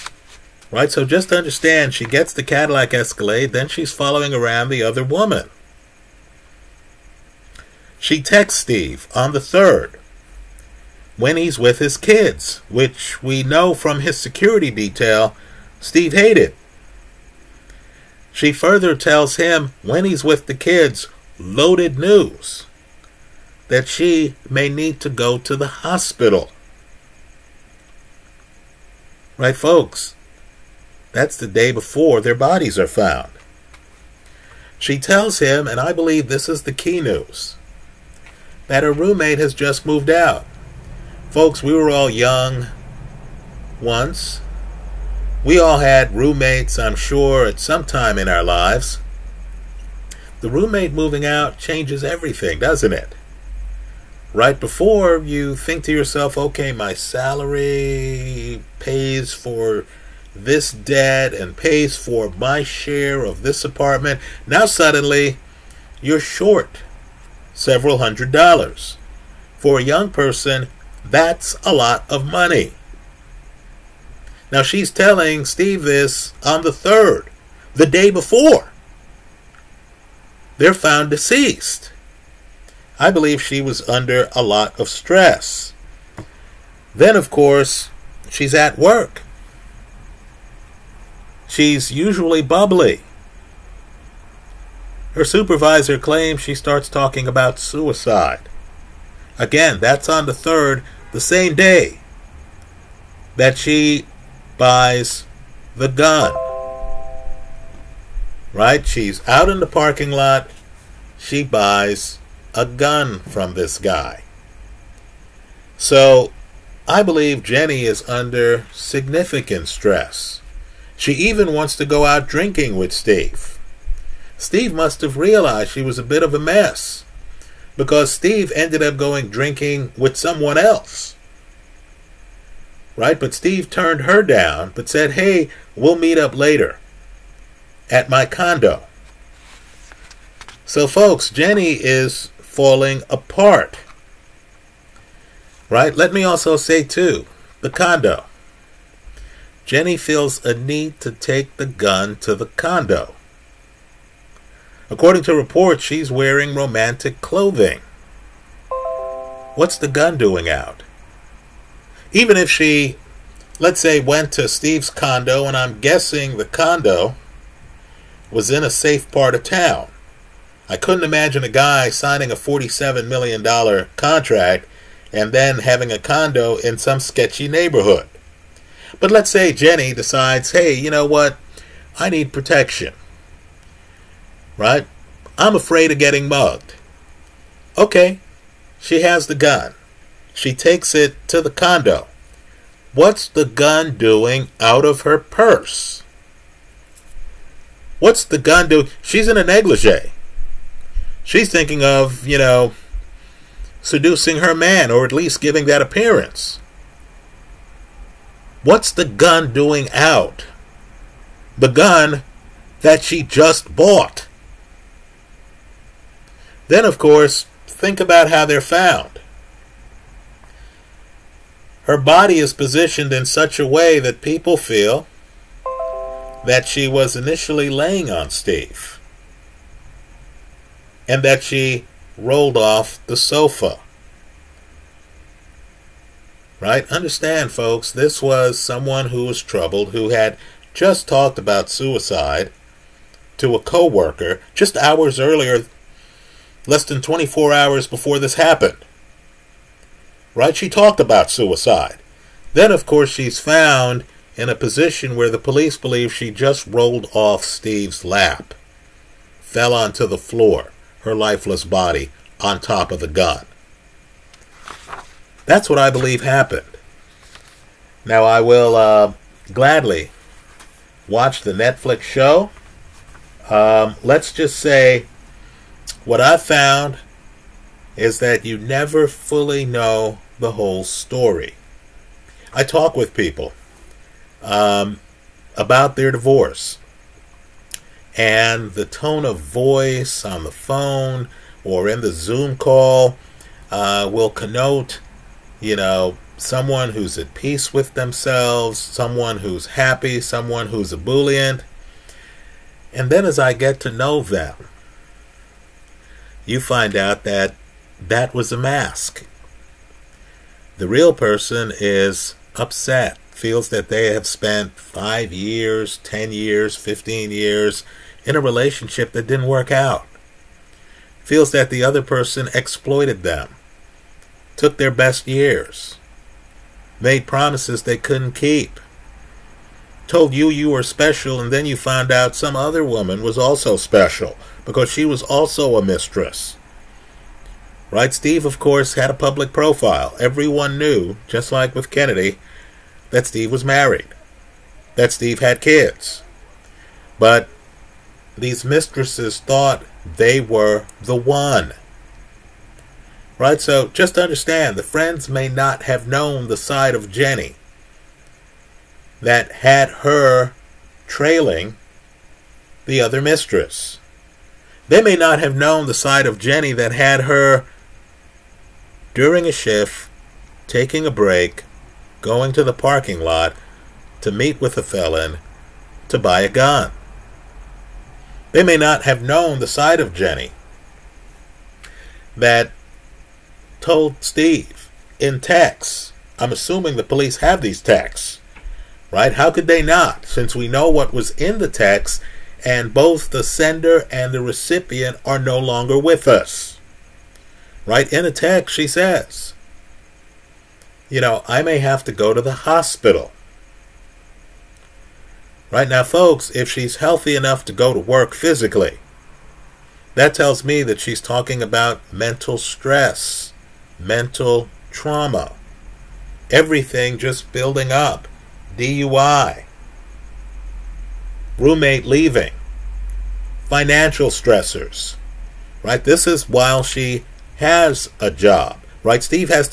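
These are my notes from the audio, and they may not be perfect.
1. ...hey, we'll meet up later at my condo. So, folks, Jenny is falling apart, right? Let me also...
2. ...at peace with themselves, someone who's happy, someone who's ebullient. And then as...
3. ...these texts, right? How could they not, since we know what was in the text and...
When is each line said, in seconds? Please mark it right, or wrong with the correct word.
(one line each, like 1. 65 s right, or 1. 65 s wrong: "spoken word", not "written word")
1. 135 s right
2. 297 s right
3. 387 s right.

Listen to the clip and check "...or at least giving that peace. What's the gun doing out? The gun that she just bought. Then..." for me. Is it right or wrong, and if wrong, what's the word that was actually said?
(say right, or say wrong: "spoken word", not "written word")
wrong: "appearance", not "peace".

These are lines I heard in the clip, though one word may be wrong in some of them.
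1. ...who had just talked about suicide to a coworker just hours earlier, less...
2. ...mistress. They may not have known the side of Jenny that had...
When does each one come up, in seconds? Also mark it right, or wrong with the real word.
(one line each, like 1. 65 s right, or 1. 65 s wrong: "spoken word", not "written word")
1. 239 s right
2. 363 s right.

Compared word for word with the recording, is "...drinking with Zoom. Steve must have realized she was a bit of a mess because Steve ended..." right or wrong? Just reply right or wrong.
wrong.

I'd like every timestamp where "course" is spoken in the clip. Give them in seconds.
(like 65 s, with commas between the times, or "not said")
87 s, 216 s, 252 s, 338 s.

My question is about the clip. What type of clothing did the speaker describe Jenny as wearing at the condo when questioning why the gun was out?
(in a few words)
A negligee.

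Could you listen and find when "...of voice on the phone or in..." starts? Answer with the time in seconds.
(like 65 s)
289 s.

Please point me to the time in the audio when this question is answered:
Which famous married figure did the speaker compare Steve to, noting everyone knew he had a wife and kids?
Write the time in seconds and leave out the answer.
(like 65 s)
341 s.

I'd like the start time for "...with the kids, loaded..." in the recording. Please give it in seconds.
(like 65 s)
20 s.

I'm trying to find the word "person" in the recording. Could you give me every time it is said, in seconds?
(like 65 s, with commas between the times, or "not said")
70 s, 311 s, 322 s.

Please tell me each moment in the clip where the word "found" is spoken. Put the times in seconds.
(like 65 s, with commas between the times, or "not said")
32 s, 80 s, 218 s, 253 s, 276 s, 331 s.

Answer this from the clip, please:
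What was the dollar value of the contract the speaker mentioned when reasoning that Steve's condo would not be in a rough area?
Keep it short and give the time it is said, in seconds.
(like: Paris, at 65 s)
$47 million, at 172 s.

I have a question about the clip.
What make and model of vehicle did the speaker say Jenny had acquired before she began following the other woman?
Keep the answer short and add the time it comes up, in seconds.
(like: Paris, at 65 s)
Cadillac Escalade, at 2 s.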